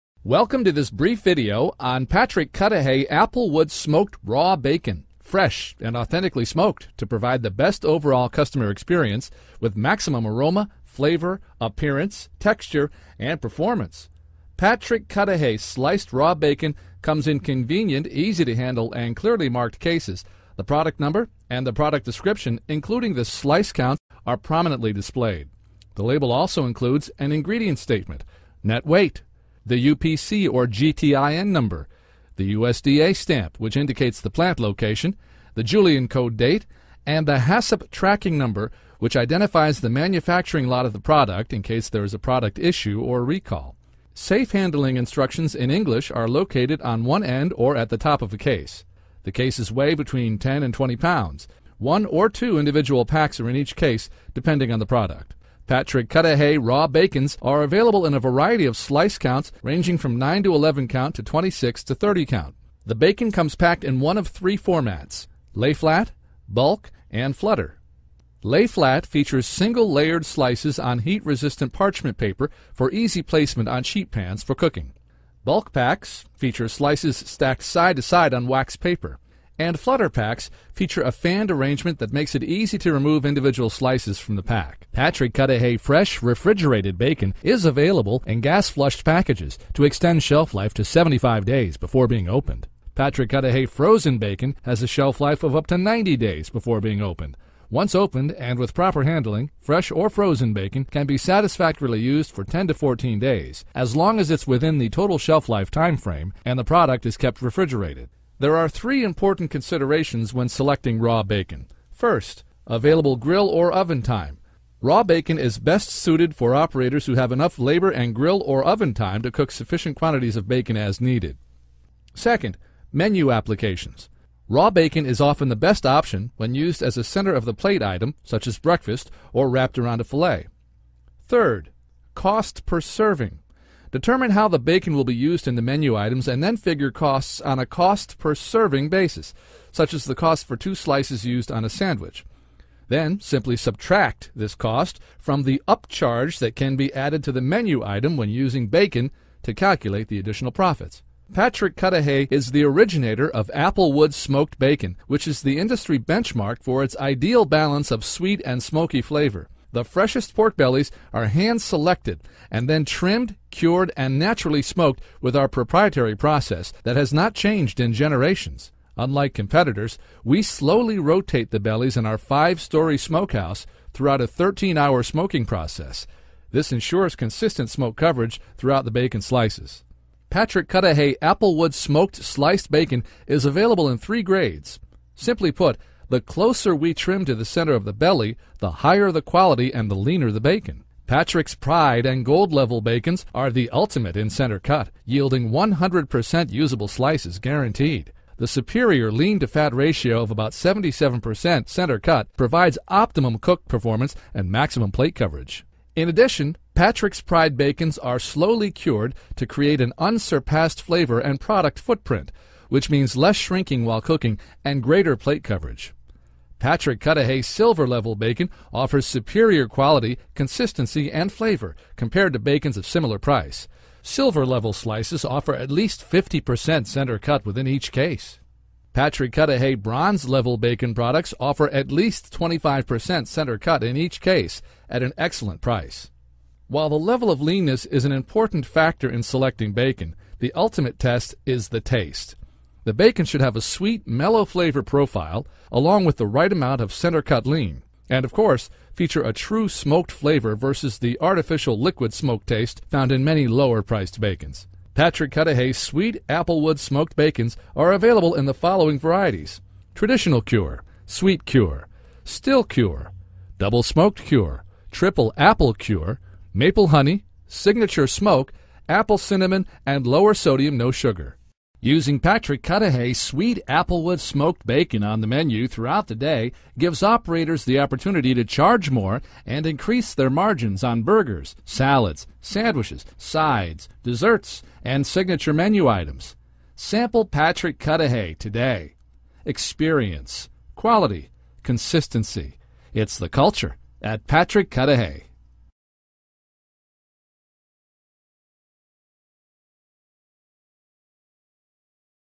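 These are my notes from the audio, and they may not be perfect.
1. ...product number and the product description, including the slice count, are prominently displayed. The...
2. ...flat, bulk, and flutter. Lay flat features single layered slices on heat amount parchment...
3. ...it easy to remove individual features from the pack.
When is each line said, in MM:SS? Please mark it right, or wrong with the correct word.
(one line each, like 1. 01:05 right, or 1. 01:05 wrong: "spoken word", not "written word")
1. 00:20 right
2. 01:05 wrong: "resistant", not "amount"
3. 01:22 wrong: "slices", not "features".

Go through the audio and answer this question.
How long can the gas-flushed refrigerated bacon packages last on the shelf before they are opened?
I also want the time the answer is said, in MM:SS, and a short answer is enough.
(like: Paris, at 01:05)
75 days, at 01:30.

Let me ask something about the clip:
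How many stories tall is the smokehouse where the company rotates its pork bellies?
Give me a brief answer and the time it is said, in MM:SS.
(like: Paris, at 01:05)
5, at 02:52.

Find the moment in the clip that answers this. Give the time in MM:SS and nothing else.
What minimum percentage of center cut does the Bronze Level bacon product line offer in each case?
03:52.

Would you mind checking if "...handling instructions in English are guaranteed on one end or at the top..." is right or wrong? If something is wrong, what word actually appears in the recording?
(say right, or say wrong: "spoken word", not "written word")
wrong: "located", not "guaranteed".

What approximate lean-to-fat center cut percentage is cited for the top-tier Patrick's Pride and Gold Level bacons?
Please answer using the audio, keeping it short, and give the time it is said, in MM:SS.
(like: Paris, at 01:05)
77%, at 03:20.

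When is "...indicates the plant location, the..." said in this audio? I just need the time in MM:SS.
00:33.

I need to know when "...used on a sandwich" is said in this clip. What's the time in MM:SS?
02:21.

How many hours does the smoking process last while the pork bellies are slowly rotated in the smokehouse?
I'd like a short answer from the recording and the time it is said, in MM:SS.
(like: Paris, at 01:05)
13 hours, at 02:54.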